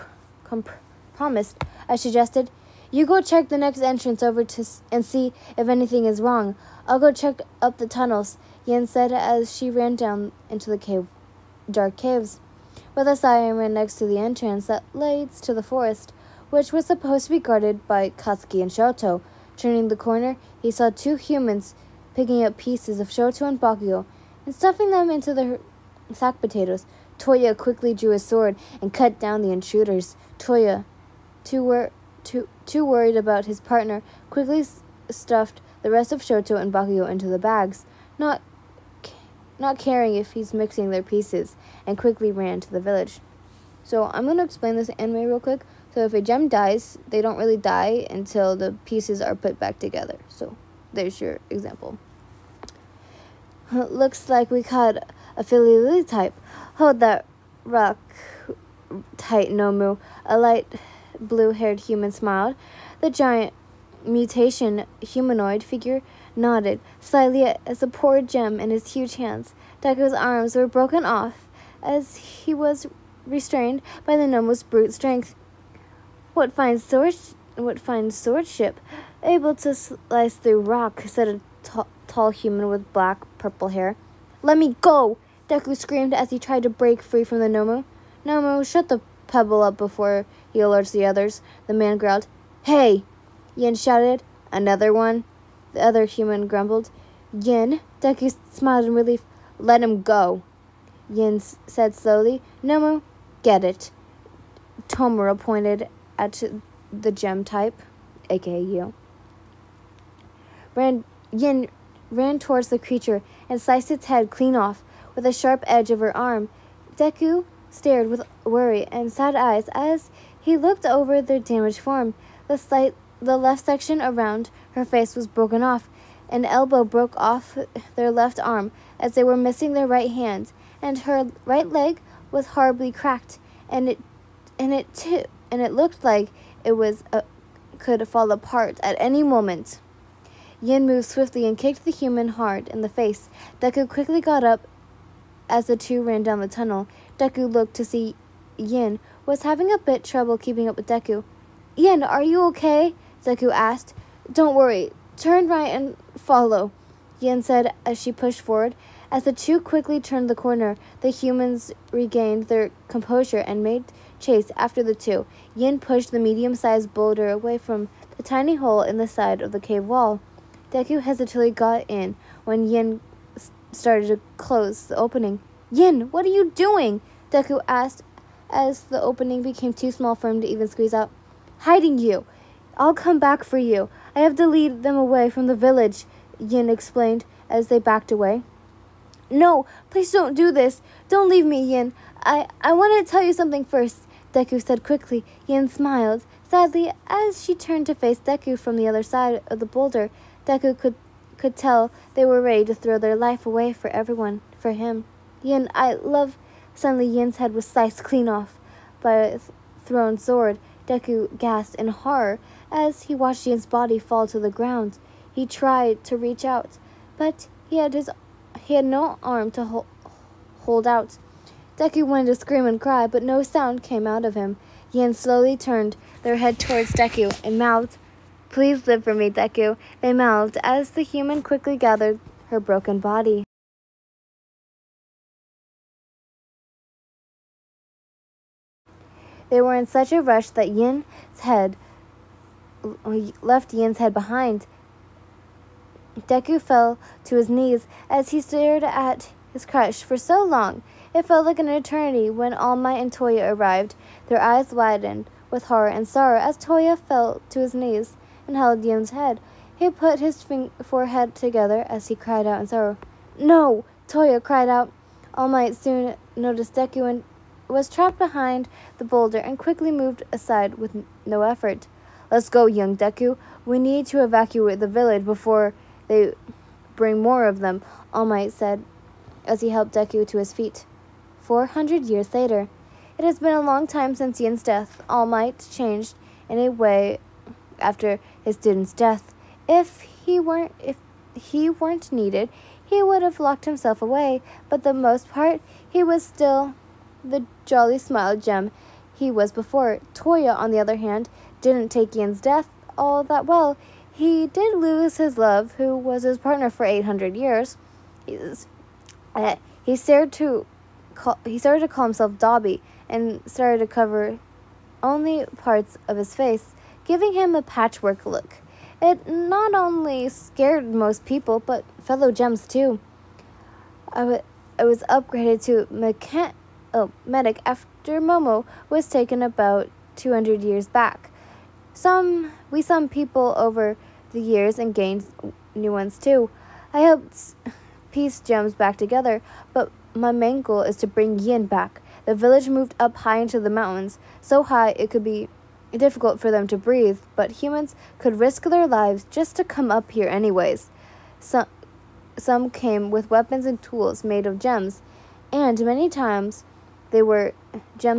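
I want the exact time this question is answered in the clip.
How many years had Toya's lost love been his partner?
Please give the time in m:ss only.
5:06.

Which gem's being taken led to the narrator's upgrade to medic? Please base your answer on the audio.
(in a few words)
Momo.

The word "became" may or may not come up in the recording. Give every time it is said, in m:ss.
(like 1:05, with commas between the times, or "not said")
2:59.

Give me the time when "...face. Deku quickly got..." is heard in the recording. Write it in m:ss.
2:22.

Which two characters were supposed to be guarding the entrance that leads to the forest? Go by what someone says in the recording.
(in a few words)
Katsuki and Shoto.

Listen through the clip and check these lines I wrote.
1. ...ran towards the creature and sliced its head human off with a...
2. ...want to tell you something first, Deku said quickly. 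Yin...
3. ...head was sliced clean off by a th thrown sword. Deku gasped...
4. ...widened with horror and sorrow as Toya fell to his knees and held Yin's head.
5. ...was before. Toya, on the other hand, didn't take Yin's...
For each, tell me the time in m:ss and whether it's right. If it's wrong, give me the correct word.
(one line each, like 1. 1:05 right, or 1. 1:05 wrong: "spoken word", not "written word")
1. 1:52 wrong: "clean", not "human"
2. 3:12 right
3. 3:27 right
4. 4:14 right
5. 4:59 right.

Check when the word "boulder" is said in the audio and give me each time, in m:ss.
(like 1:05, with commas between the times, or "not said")
2:46, 3:19, 4:29.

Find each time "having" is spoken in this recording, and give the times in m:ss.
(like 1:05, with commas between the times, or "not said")
2:29.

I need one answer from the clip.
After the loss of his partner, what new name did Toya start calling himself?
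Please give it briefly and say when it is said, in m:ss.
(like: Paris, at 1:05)
Dabi, at 5:12.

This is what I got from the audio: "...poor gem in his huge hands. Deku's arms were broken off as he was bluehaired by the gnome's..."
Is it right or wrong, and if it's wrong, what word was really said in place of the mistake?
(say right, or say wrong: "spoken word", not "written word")
wrong: "restrained", not "bluehaired".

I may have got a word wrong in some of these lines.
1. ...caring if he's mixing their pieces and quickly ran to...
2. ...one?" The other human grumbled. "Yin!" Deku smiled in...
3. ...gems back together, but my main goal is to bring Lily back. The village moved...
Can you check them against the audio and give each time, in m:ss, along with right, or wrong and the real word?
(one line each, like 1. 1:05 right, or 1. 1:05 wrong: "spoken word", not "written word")
1. 0:39 right
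2. 1:34 right
3. 5:38 wrong: "Yin", not "Lily".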